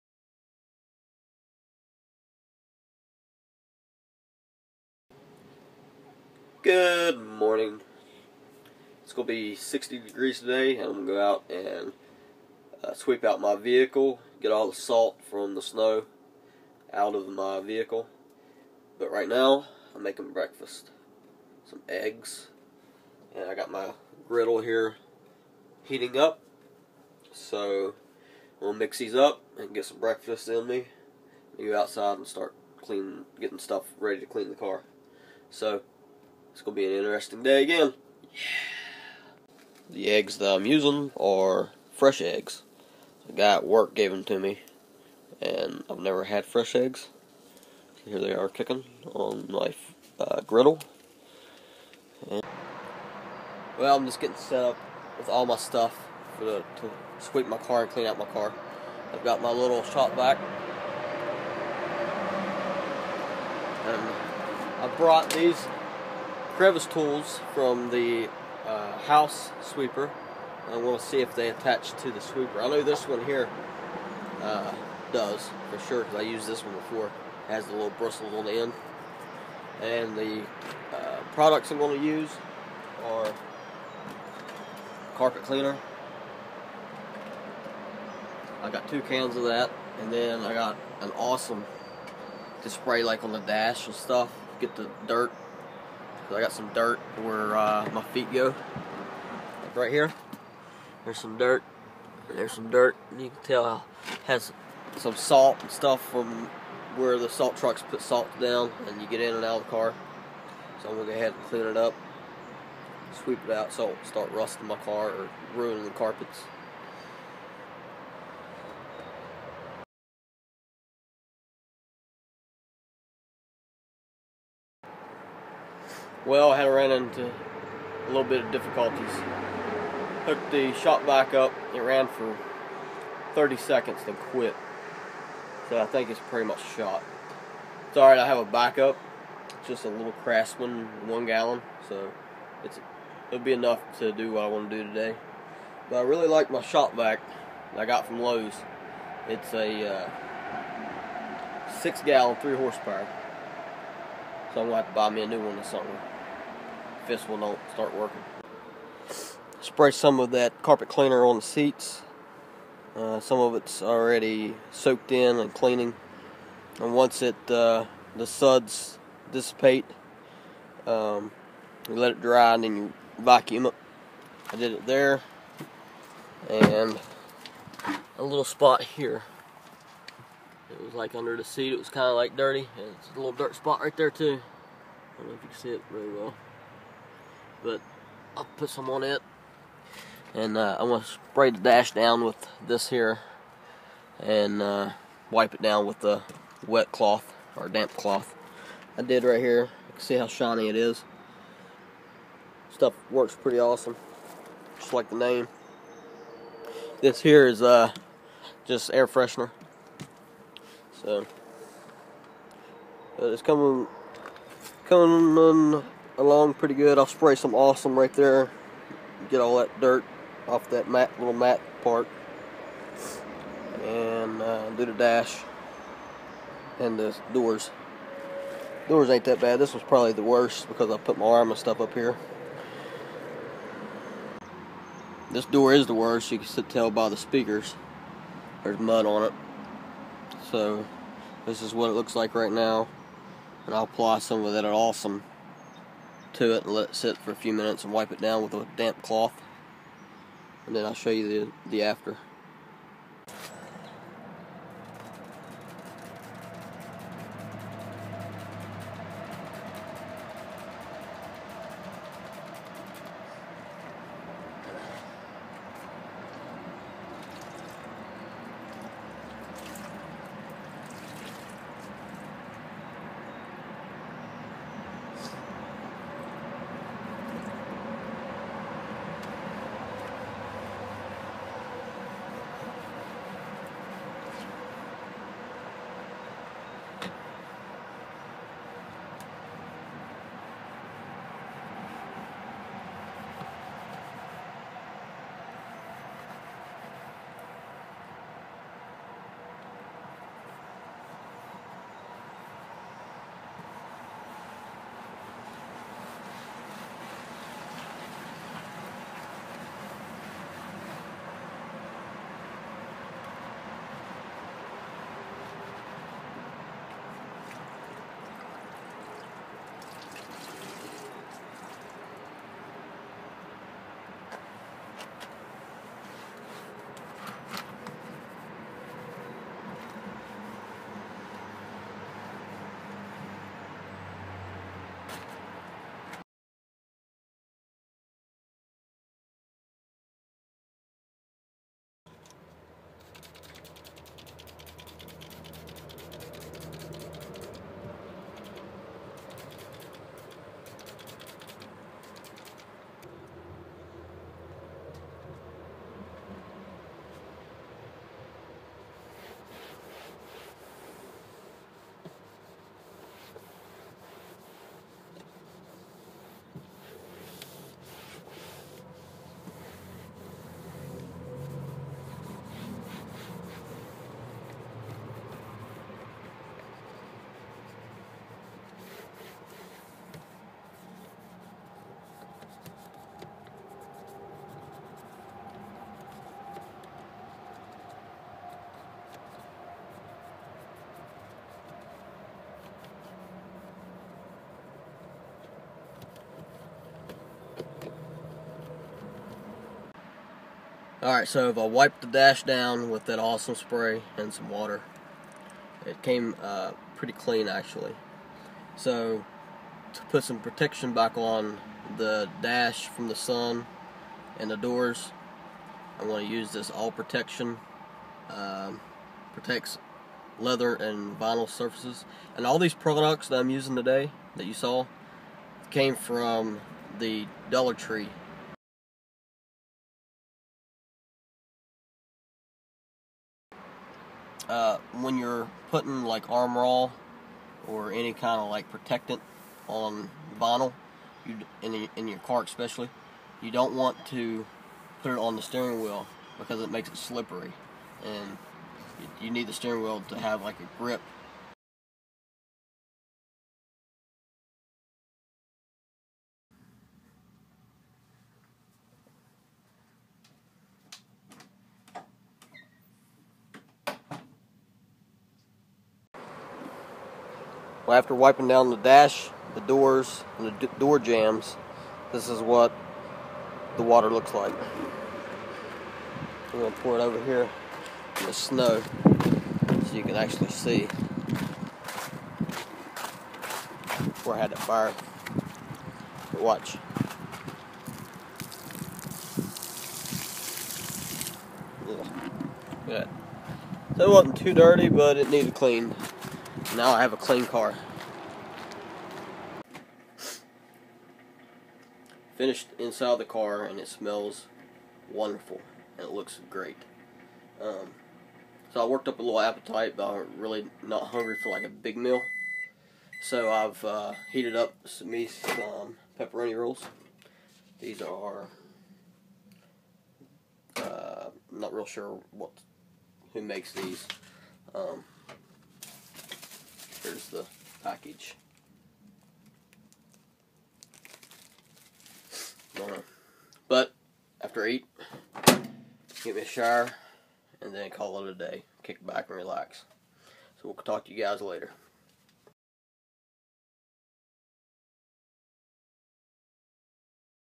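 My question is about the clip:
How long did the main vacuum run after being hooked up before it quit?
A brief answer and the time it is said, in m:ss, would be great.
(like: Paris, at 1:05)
30 seconds, at 2:13.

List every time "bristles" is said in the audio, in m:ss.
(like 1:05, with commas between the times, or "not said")
1:17.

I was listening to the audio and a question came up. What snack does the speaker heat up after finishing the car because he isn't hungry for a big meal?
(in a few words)
pepperoni rolls.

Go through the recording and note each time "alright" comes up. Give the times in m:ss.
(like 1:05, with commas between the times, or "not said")
2:17, 6:41.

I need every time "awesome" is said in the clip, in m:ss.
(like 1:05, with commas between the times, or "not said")
1:31, 3:23, 3:37, 4:04, 6:43.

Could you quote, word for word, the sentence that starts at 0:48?
Here they are cooking on my uh, griddle.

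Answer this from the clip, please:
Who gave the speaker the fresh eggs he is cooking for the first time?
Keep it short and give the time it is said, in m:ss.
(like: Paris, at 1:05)
the guy at work, at 0:43.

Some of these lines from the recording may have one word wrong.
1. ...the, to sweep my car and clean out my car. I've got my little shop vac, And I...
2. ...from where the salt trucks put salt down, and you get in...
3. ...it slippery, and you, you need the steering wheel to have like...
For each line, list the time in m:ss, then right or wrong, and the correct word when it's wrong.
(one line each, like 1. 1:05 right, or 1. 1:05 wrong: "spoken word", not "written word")
1. 0:56 right
2. 1:46 right
3. 7:26 right.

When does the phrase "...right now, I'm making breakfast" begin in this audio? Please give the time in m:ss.
0:19.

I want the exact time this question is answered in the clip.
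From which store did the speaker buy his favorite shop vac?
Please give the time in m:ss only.
2:28.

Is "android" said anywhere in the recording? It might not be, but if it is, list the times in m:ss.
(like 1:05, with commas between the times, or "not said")
not said.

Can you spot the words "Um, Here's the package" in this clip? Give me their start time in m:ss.
8:44.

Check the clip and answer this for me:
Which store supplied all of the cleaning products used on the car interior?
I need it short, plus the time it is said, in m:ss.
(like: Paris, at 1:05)
Dollar Tree, at 7:07.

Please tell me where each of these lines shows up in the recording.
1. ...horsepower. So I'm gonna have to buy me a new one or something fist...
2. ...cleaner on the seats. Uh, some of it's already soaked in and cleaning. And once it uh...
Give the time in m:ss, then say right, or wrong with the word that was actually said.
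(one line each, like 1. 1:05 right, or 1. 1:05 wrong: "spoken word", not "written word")
1. 2:32 right
2. 2:40 right.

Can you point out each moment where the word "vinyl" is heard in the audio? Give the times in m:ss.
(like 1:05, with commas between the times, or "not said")
7:01, 7:20.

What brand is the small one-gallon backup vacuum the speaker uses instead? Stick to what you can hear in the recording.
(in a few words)
Craftsman.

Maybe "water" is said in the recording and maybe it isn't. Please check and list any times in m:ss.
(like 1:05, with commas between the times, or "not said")
6:44, 7:53.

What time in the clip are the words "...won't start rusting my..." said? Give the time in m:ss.
1:53.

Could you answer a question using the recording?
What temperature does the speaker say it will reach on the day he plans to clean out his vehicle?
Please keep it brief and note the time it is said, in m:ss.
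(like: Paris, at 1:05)
60 degrees, at 0:09.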